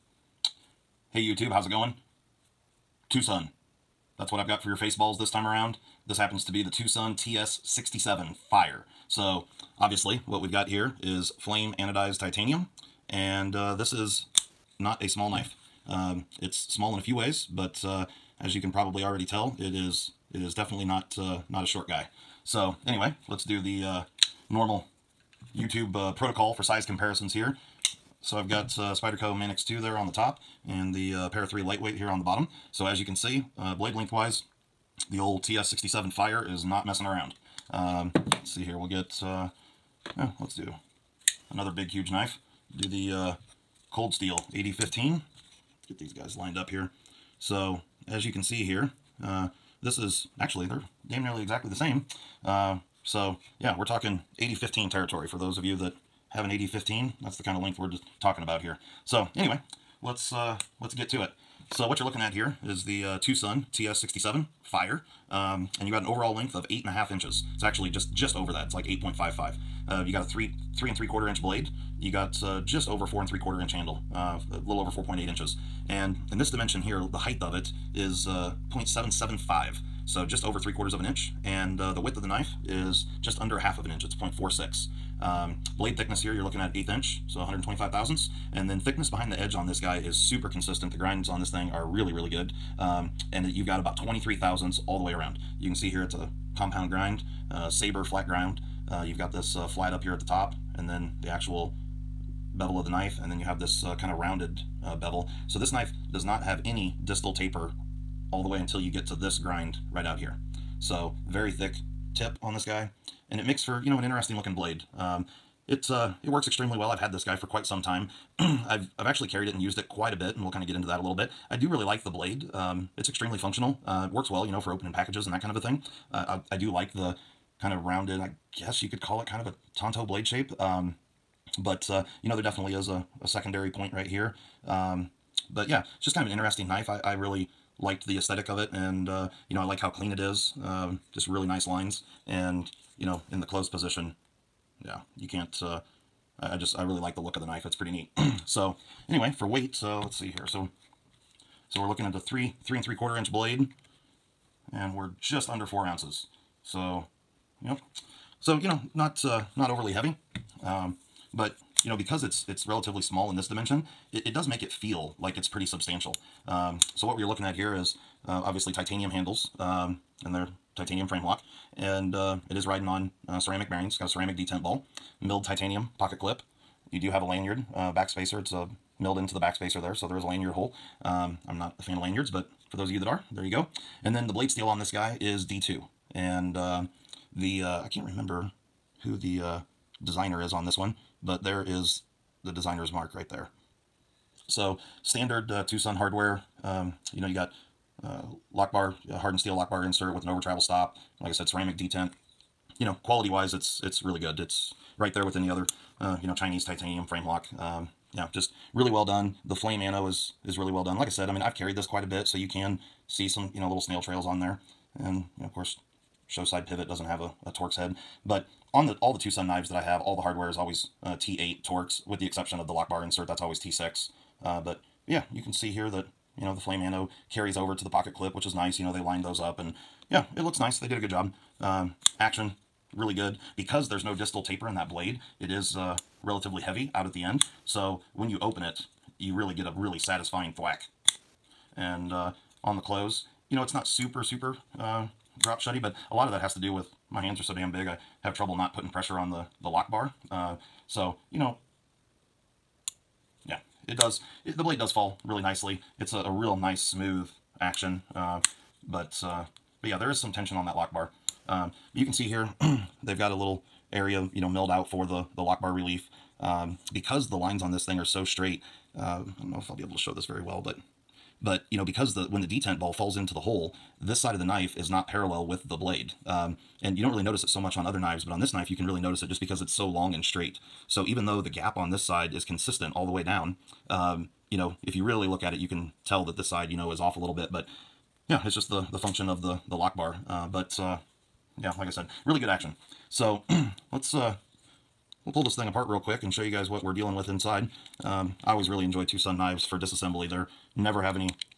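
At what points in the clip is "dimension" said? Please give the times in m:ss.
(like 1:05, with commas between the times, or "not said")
1:16, 2:43.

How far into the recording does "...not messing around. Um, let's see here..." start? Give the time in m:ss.
0:36.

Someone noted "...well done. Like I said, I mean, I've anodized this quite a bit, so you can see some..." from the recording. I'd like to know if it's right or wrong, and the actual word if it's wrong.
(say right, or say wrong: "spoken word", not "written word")
wrong: "carried", not "anodized".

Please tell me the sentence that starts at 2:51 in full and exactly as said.
And uh, it is riding on uh, ceramic bearings.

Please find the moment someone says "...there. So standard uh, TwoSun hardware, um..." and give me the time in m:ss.
3:13.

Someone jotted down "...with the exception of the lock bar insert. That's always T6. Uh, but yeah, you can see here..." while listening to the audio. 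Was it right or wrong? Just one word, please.
right.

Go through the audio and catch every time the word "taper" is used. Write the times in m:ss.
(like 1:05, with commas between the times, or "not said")
1:47, 3:54.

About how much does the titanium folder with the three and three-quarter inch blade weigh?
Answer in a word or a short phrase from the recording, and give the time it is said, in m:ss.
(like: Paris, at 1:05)
just under 4 ounces, at 2:35.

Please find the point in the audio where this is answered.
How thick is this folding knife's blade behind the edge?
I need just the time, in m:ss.
1:33.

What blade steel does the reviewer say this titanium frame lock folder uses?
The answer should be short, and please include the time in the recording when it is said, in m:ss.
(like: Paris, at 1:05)
D2, at 3:05.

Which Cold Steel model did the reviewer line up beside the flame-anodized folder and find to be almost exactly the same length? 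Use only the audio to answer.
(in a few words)
8015.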